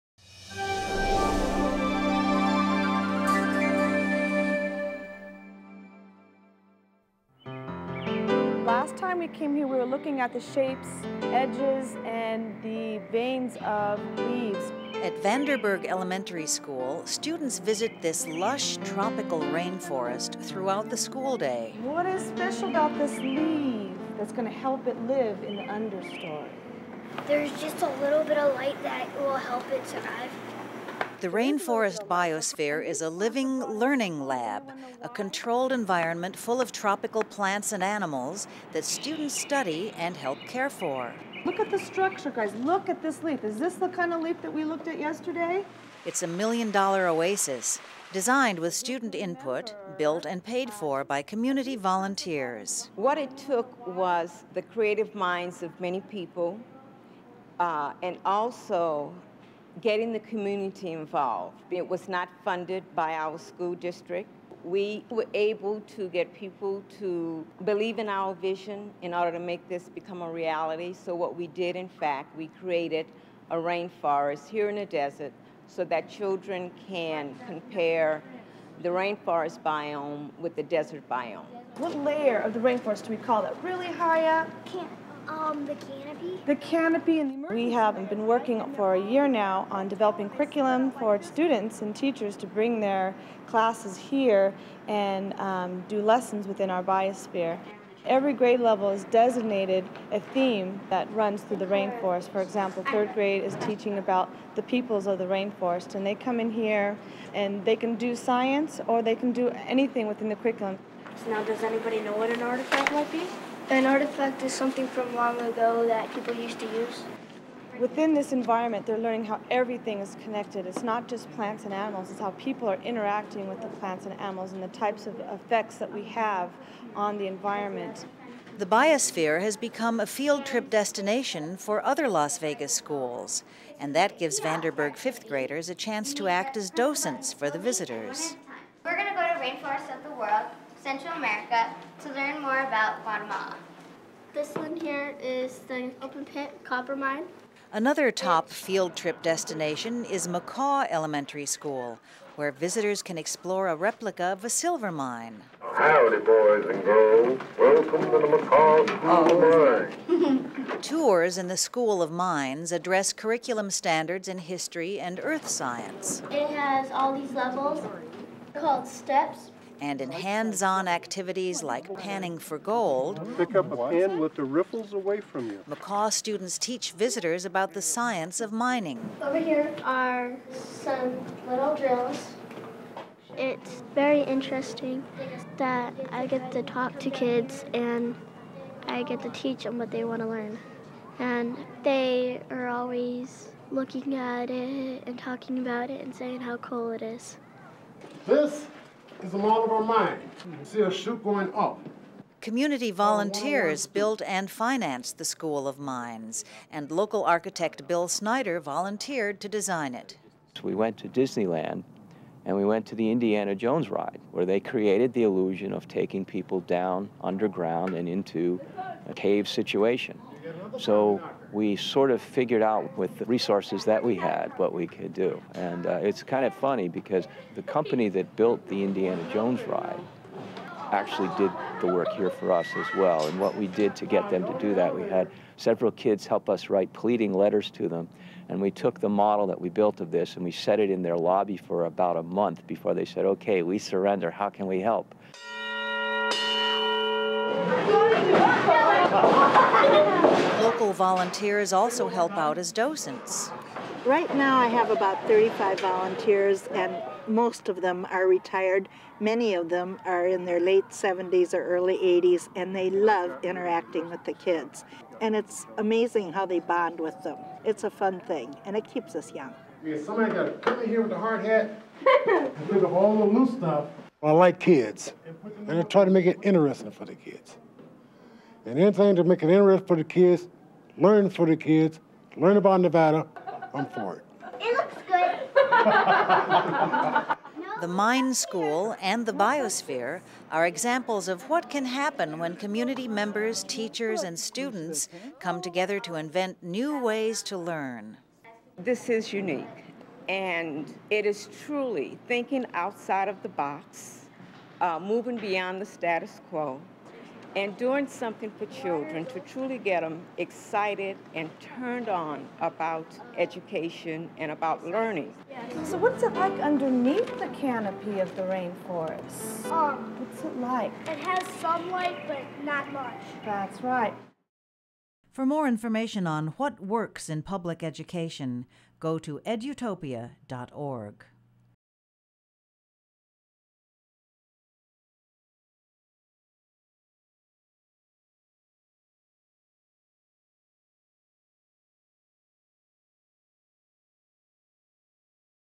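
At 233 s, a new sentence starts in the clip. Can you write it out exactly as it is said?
And what we did to get them to do that, we had several kids help us write pleading letters to them.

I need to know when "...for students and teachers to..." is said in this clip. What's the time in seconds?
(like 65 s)
90 s.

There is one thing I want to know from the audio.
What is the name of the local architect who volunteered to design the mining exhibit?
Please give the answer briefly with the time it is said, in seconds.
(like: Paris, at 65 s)
Bill Snyder, at 207 s.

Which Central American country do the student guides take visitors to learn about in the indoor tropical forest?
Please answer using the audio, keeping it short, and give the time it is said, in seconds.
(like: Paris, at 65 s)
Guatemala, at 143 s.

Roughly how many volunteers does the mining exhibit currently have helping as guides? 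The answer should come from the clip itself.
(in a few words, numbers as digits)
35.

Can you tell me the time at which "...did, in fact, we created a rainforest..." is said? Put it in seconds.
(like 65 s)
71 s.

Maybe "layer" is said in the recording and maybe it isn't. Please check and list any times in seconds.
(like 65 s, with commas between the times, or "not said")
82 s.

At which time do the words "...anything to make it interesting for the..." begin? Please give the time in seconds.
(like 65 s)
278 s.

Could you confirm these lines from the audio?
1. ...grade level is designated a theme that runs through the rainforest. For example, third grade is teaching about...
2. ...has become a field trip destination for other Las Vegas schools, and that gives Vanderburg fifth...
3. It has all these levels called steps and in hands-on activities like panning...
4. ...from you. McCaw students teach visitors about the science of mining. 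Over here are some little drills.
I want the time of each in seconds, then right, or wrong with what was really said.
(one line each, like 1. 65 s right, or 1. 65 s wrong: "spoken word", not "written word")
1. 98 s right
2. 129 s right
3. 166 s right
4. 175 s right.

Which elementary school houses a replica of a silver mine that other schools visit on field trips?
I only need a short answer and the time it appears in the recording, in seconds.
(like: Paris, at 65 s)
McCaw Elementary School, at 150 s.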